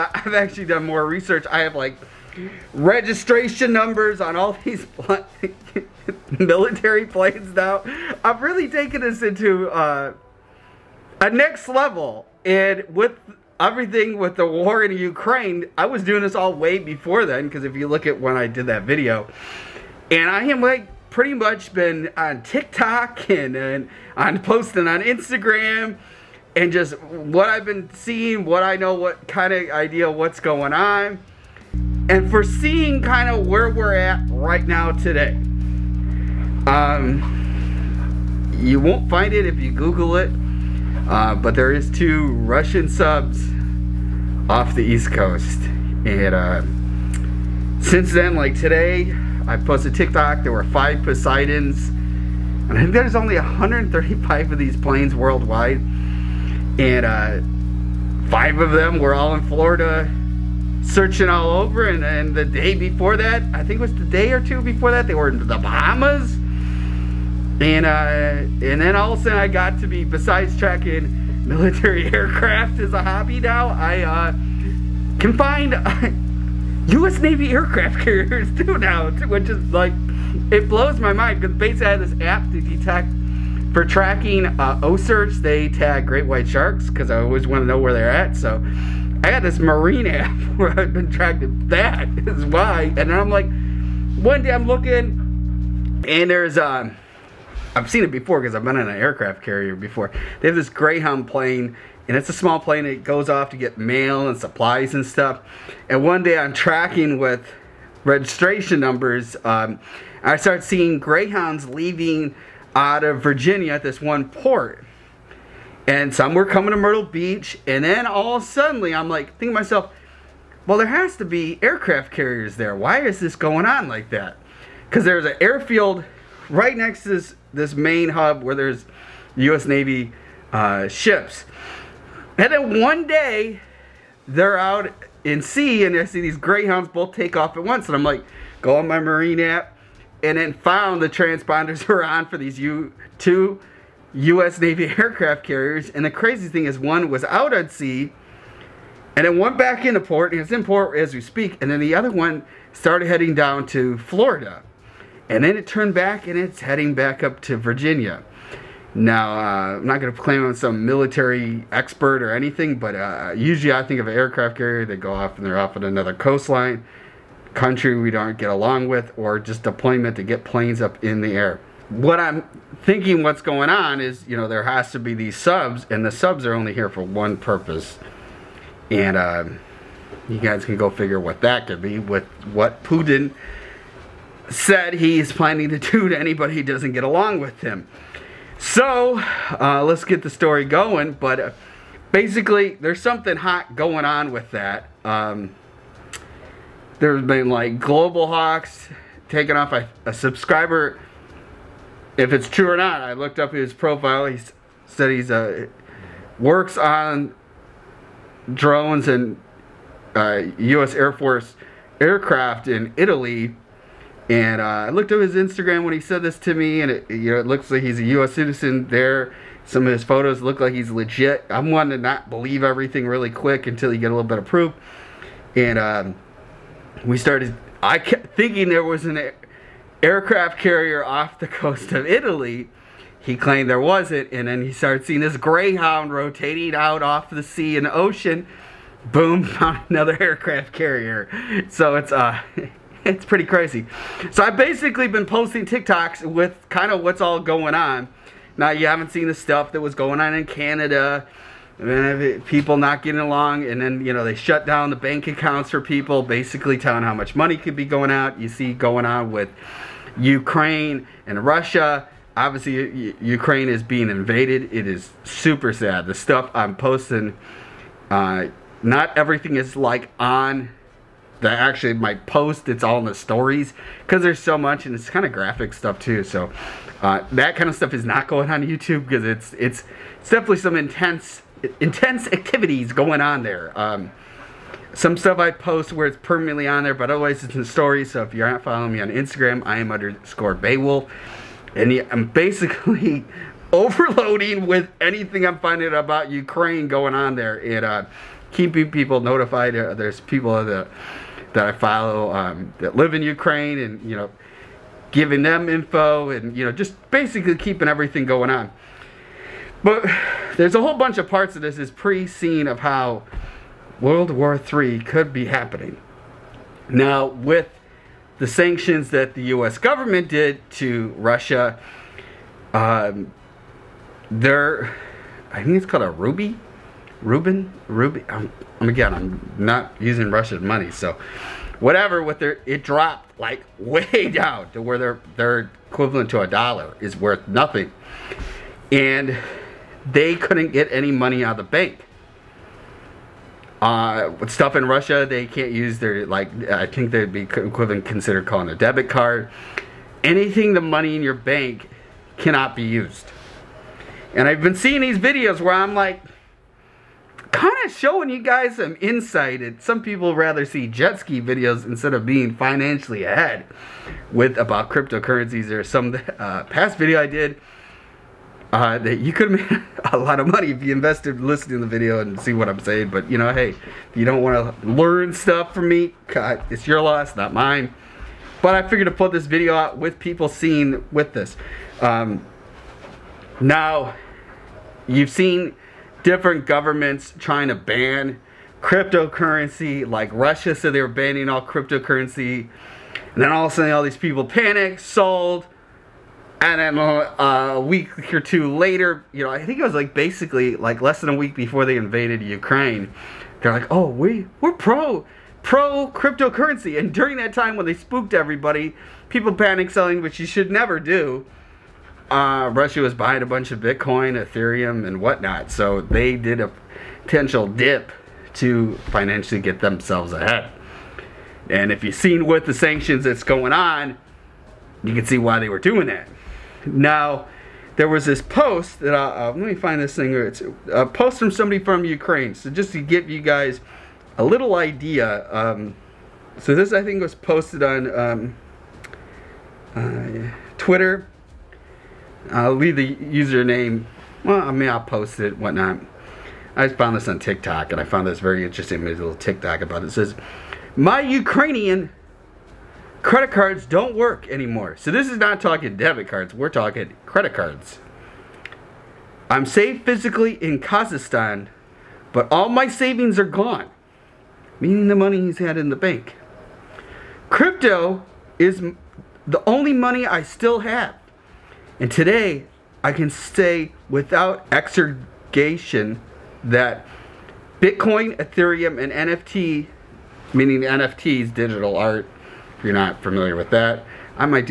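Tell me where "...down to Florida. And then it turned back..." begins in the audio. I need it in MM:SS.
02:33.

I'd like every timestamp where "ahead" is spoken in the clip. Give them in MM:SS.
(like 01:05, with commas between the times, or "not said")
06:03, 07:00.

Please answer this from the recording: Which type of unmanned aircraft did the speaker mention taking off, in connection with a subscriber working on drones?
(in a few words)
Global Hawks.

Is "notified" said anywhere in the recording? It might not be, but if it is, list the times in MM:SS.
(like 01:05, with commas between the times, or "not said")
04:59.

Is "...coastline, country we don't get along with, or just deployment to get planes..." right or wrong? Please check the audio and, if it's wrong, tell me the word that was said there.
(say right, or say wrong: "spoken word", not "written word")
right.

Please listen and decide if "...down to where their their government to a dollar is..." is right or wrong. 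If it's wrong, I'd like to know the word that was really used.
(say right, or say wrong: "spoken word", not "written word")
wrong: "equivalent", not "government".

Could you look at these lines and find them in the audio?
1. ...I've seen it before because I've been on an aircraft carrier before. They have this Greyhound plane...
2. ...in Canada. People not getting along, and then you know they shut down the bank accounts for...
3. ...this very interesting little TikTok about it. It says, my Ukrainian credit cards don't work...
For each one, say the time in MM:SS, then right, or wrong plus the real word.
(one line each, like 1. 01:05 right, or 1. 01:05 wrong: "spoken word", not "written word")
1. 01:37 right
2. 04:10 right
3. 07:28 right.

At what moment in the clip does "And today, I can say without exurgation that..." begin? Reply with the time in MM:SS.
07:51.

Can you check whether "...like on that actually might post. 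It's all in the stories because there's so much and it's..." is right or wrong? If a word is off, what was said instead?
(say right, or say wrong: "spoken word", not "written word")
right.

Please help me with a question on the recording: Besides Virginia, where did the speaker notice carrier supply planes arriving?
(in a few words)
Myrtle Beach.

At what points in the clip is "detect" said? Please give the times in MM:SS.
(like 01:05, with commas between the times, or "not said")
01:22.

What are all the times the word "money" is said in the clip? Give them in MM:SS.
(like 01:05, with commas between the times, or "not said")
04:17, 05:30, 05:41, 05:50, 06:10, 07:45, 07:49.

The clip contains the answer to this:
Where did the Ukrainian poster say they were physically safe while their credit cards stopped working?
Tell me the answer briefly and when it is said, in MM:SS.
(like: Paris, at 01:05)
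Kazakhstan, at 07:40.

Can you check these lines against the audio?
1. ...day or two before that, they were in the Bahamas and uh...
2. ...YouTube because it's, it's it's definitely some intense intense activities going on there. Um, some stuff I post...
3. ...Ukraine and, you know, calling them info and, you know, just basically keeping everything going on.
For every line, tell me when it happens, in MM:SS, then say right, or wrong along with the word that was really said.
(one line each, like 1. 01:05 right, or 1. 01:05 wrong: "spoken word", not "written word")
1. 01:04 right
2. 04:38 right
3. 05:03 wrong: "giving", not "calling".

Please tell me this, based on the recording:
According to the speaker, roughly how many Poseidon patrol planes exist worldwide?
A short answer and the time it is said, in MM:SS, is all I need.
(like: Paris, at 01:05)
135, at 00:53.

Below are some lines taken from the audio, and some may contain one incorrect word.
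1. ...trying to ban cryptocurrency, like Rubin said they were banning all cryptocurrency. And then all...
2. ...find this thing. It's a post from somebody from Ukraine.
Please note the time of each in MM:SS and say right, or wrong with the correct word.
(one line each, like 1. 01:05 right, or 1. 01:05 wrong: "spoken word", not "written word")
1. 06:27 wrong: "Russia", not "Rubin"
2. 07:09 right.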